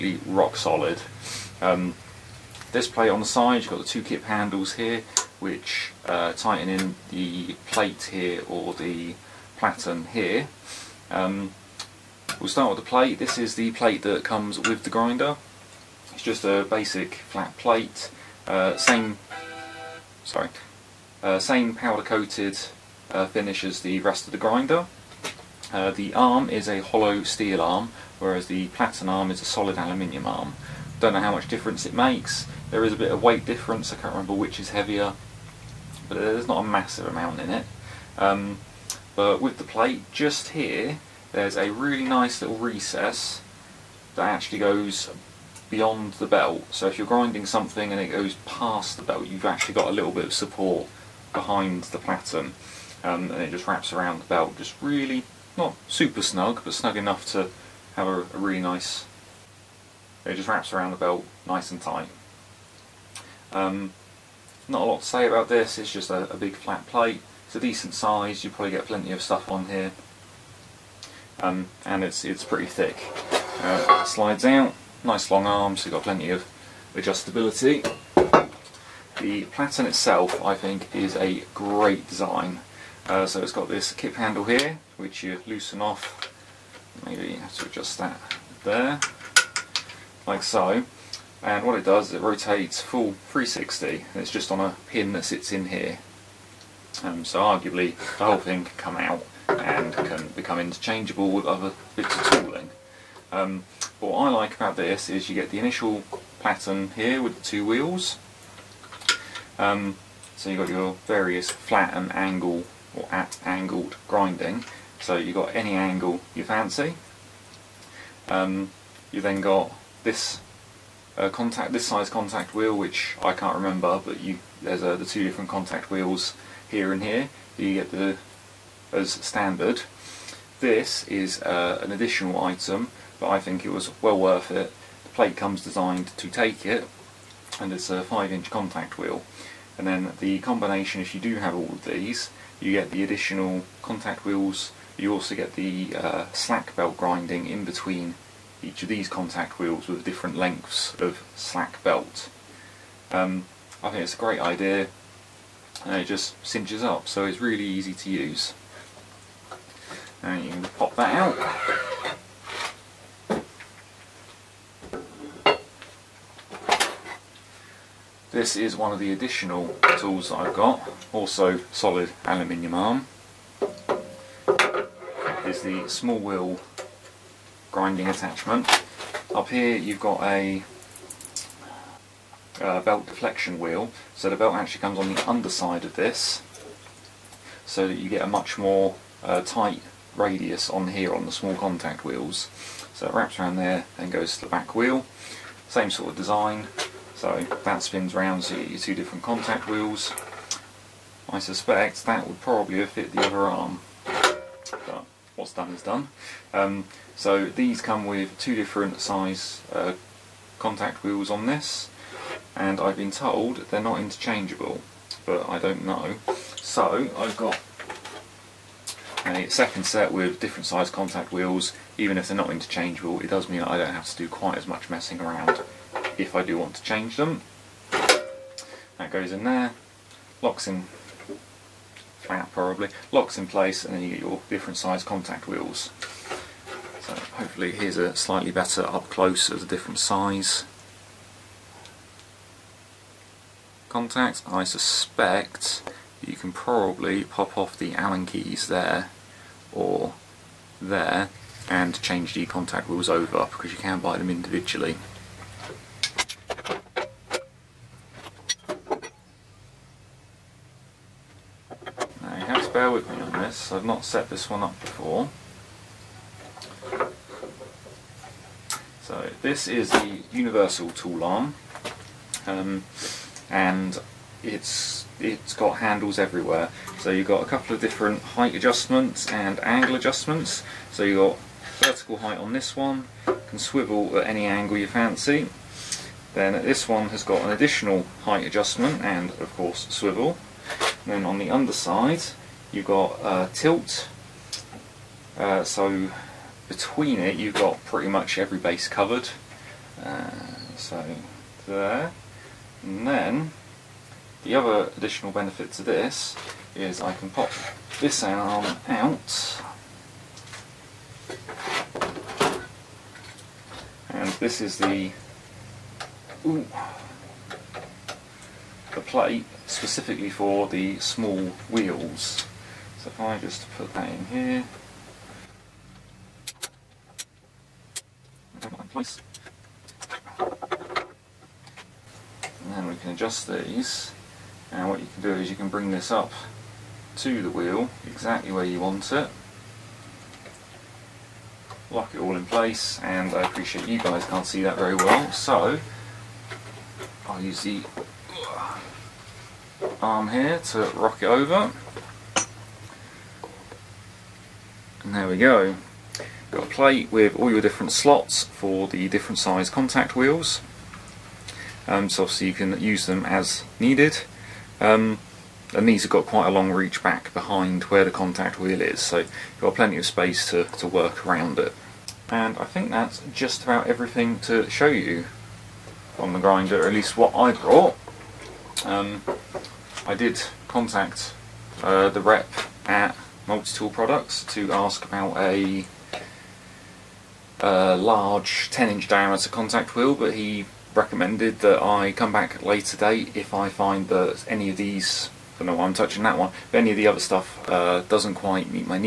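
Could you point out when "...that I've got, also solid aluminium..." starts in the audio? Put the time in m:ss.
2:50.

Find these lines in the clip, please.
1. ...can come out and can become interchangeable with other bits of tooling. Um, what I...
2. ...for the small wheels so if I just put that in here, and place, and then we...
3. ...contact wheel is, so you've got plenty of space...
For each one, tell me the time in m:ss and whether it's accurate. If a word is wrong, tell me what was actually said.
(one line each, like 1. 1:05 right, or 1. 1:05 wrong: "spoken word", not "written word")
1. 1:38 right
2. 5:20 right
3. 6:08 right.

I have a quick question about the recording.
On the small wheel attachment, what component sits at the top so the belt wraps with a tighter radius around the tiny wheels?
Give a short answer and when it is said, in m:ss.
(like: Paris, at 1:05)
belt deflection wheel, at 3:02.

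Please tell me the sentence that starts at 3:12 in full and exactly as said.
So it wraps around there and goes to the back wheel.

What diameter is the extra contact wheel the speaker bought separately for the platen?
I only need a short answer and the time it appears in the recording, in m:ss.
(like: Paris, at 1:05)
5-inch, at 2:18.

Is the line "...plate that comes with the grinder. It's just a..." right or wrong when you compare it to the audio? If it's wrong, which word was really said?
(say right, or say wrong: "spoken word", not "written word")
right.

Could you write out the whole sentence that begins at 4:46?
Then this one has got an additional height adjustment and of course swivel.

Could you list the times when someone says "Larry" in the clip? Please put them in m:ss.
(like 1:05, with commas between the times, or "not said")
not said.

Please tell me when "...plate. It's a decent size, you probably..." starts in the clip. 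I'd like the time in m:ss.
1:06.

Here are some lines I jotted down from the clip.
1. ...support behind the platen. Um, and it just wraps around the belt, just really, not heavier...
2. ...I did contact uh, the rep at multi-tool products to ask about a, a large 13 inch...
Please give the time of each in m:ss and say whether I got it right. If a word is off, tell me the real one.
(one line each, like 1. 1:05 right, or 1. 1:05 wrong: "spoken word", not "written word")
1. 0:50 wrong: "super", not "heavier"
2. 6:20 wrong: "10", not "13".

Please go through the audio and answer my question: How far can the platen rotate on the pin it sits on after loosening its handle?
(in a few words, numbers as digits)
full 360.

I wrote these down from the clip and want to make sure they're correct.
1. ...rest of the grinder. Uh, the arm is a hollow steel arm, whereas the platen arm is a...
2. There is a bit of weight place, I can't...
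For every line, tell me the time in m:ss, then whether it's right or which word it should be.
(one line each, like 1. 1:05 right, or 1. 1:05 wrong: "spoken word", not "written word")
1. 0:24 right
2. 0:32 wrong: "difference", not "place".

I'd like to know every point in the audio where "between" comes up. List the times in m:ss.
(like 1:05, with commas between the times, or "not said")
2:27, 4:56.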